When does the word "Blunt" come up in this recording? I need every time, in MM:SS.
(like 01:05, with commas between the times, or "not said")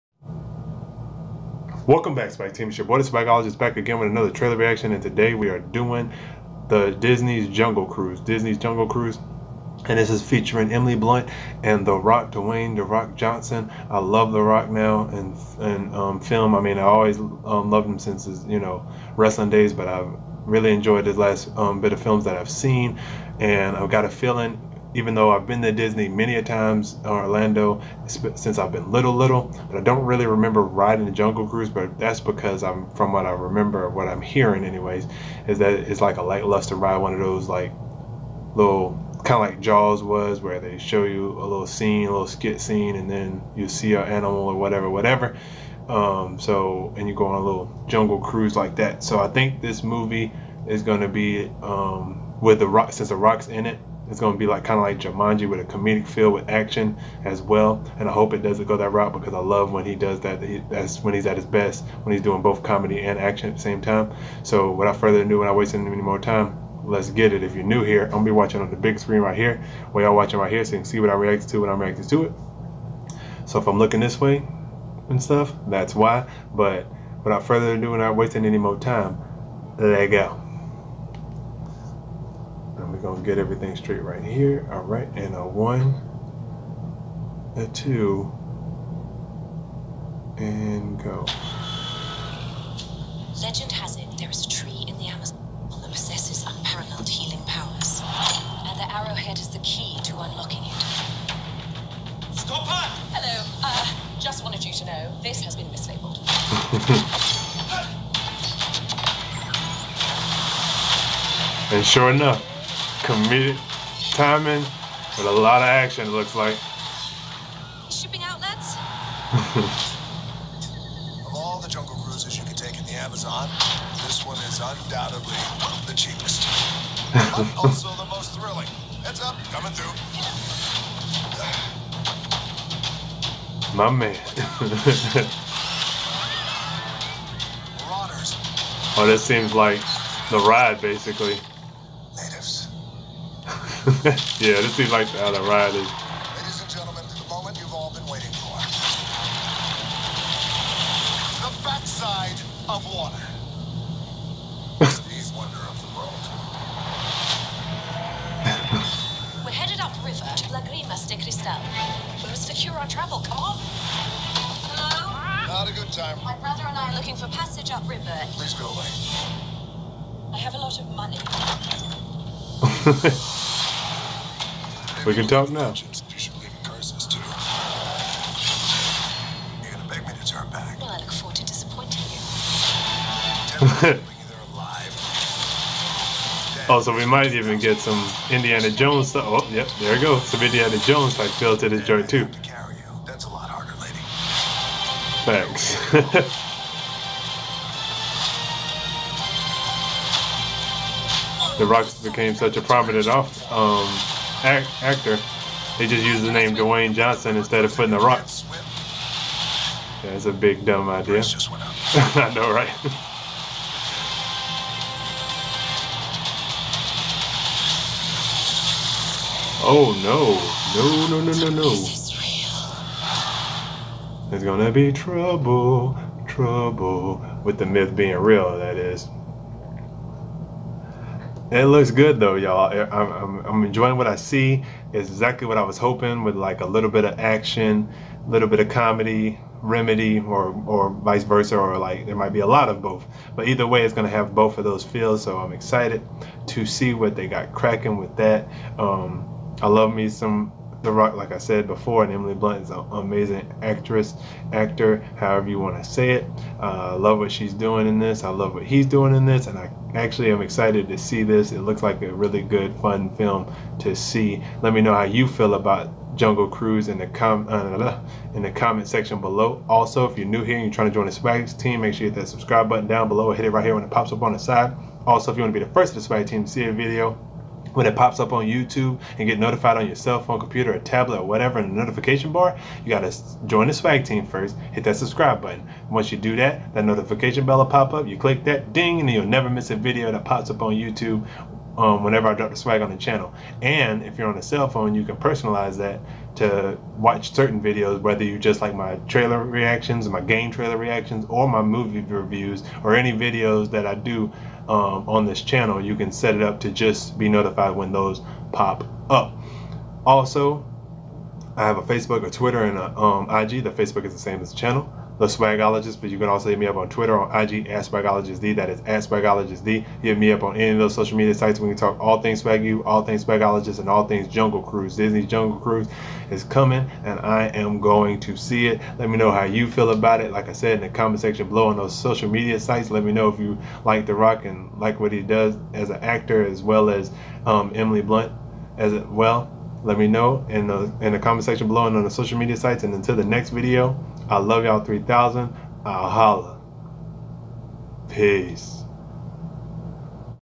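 00:10, 04:12, 05:38.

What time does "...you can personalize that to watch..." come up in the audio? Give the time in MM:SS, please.
04:54.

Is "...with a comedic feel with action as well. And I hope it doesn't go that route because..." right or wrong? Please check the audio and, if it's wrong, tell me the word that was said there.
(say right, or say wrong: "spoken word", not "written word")
right.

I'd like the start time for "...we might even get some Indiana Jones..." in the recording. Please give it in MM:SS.
03:06.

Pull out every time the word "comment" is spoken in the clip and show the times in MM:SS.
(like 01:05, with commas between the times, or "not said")
04:28, 05:30, 05:41.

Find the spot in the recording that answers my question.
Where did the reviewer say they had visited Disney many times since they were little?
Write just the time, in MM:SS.
00:27.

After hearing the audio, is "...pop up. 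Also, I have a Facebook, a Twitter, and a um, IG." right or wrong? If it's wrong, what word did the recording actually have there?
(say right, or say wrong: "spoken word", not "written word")
right.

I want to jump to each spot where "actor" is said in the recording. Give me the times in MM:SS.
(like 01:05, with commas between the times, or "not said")
03:24, 04:14, 05:36.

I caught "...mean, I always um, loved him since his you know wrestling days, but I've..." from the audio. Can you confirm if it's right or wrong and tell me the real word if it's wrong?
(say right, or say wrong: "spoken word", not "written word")
right.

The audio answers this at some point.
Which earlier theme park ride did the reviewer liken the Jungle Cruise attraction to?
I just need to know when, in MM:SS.
00:39.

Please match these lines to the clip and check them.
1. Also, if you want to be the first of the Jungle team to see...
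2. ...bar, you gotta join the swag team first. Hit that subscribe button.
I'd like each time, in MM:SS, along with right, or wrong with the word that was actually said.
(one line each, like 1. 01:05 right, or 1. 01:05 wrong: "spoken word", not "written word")
1. 04:35 wrong: "Swag", not "Jungle"
2. 04:42 right.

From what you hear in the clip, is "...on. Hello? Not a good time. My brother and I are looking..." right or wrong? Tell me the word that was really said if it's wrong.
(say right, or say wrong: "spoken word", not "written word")
right.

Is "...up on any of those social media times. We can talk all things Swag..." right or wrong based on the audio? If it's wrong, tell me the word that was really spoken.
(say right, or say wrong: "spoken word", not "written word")
wrong: "sites", not "times".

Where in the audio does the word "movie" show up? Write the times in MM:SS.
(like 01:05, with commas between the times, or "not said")
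00:49, 05:01.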